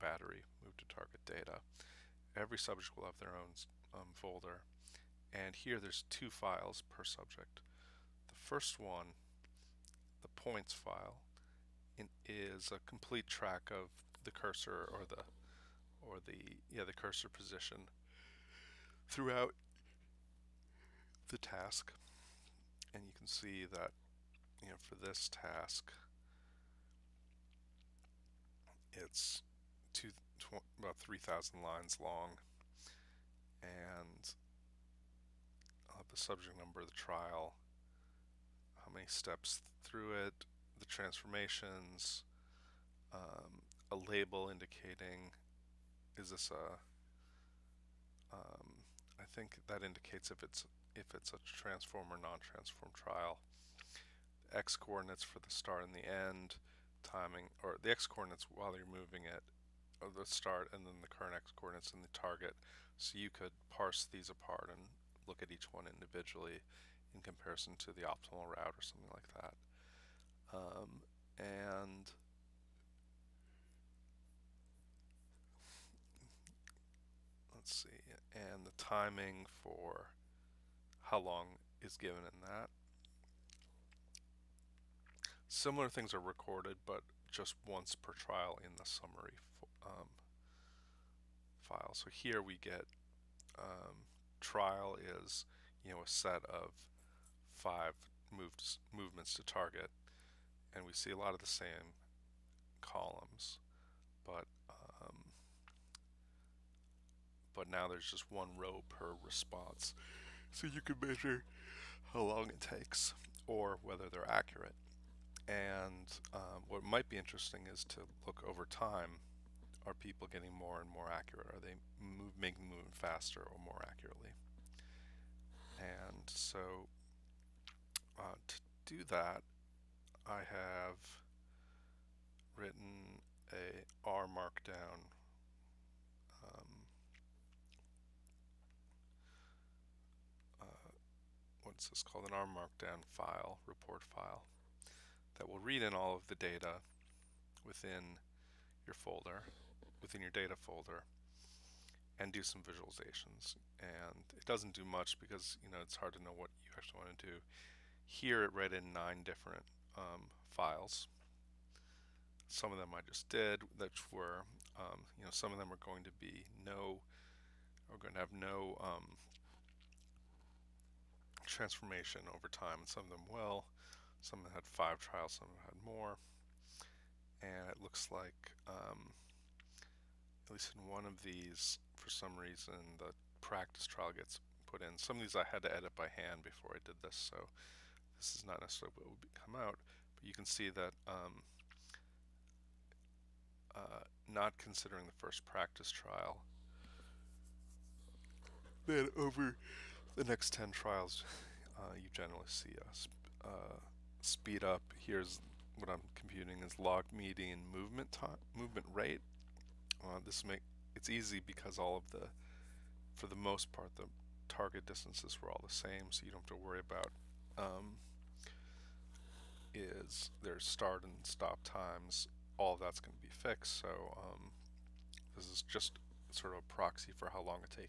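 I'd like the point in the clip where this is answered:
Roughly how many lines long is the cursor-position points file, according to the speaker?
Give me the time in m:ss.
0:30.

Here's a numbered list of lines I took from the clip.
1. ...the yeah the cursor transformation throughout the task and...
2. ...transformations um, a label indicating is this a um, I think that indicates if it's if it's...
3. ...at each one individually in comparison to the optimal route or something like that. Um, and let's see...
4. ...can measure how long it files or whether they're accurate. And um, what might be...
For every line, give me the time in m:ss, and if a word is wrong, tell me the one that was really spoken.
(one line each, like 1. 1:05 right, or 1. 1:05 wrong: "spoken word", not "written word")
1. 0:16 wrong: "position", not "transformation"
2. 0:40 right
3. 1:05 right
4. 1:50 wrong: "takes", not "files".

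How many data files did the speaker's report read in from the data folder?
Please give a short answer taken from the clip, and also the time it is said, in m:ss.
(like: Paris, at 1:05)
9, at 2:38.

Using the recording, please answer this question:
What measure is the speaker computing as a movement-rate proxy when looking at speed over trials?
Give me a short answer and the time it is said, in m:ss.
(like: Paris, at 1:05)
log median movement time, at 3:26.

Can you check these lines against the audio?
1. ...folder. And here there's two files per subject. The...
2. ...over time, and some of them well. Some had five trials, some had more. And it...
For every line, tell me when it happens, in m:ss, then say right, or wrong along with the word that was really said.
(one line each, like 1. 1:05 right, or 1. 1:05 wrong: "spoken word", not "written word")
1. 0:04 right
2. 2:52 right.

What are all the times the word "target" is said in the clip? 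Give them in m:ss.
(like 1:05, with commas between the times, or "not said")
0:00, 1:02, 1:39, 3:34.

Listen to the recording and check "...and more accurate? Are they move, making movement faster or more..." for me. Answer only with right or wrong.
right.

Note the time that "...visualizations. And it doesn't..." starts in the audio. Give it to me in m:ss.
2:32.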